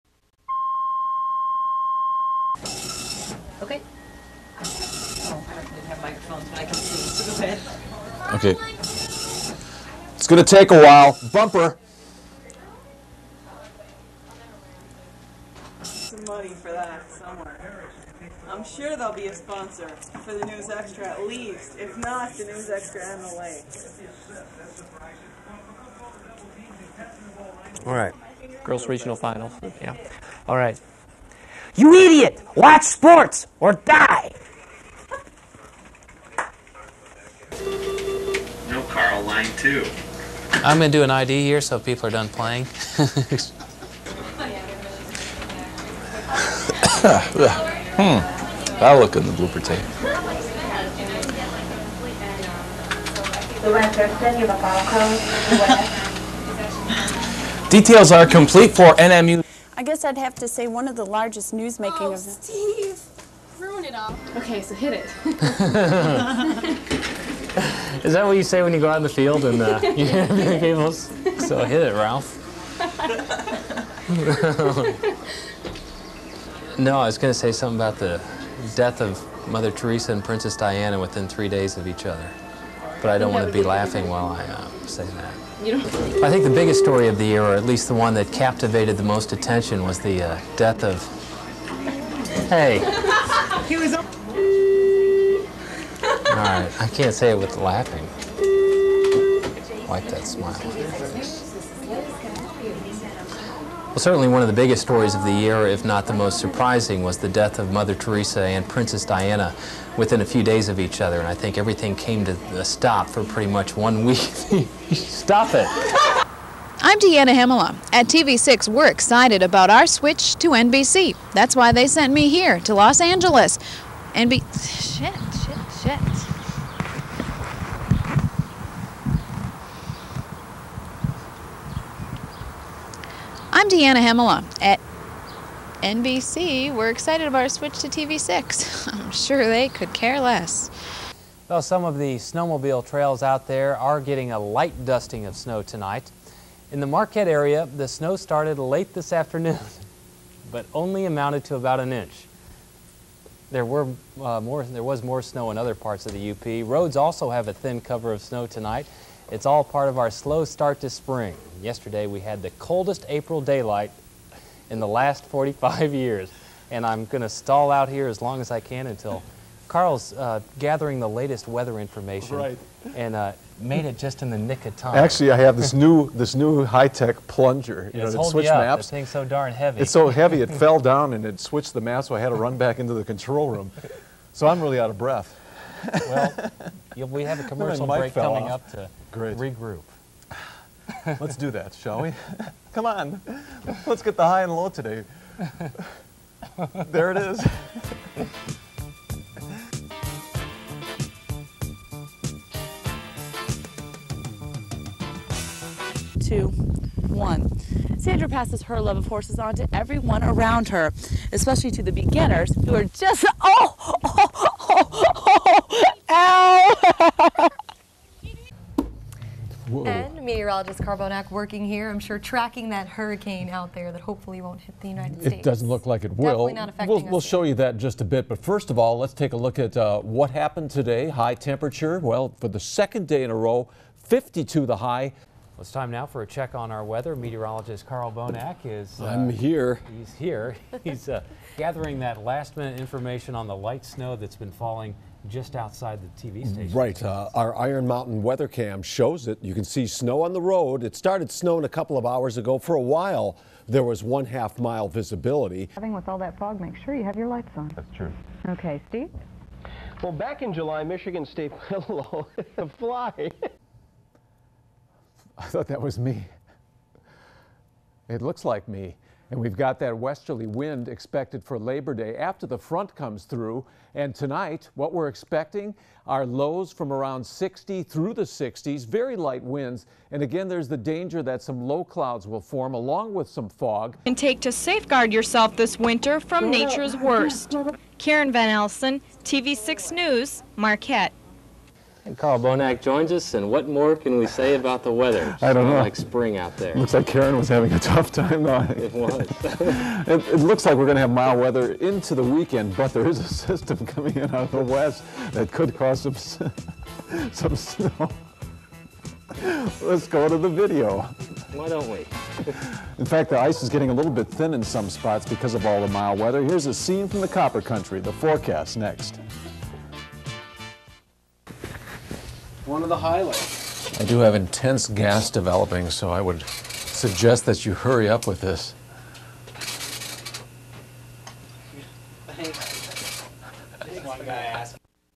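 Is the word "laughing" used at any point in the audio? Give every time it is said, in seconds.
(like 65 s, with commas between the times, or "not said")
83 s, 97 s.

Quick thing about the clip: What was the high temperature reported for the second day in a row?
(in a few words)
52.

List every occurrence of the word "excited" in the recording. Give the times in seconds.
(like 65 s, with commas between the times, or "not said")
118 s, 136 s.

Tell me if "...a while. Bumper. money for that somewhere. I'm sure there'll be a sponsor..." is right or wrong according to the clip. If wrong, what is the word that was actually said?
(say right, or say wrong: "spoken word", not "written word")
right.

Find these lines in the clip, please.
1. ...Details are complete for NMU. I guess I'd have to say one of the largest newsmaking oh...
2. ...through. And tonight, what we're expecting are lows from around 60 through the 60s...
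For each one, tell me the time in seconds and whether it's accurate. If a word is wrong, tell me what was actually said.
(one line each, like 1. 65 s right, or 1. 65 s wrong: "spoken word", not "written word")
1. 57 s right
2. 273 s right.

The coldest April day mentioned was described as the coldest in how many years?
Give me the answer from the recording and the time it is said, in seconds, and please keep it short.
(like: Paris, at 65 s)
45, at 165 s.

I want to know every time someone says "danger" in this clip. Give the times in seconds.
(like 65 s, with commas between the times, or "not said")
280 s.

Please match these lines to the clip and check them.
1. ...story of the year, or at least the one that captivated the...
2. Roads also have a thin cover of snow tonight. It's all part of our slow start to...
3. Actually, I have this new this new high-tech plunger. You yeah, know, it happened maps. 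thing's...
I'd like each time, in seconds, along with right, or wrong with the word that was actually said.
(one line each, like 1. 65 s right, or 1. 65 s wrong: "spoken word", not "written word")
1. 86 s right
2. 156 s right
3. 174 s wrong: "switched", not "happened".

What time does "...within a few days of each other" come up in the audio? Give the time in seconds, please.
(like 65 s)
109 s.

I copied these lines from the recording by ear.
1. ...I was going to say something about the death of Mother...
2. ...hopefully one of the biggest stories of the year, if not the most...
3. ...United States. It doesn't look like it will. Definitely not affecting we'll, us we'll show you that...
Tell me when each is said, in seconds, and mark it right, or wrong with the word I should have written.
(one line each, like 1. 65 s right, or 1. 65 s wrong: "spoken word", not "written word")
1. 76 s right
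2. 103 s wrong: "certainly", not "hopefully"
3. 224 s right.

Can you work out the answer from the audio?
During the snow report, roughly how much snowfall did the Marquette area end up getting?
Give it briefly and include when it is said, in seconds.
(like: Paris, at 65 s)
about an inch, at 151 s.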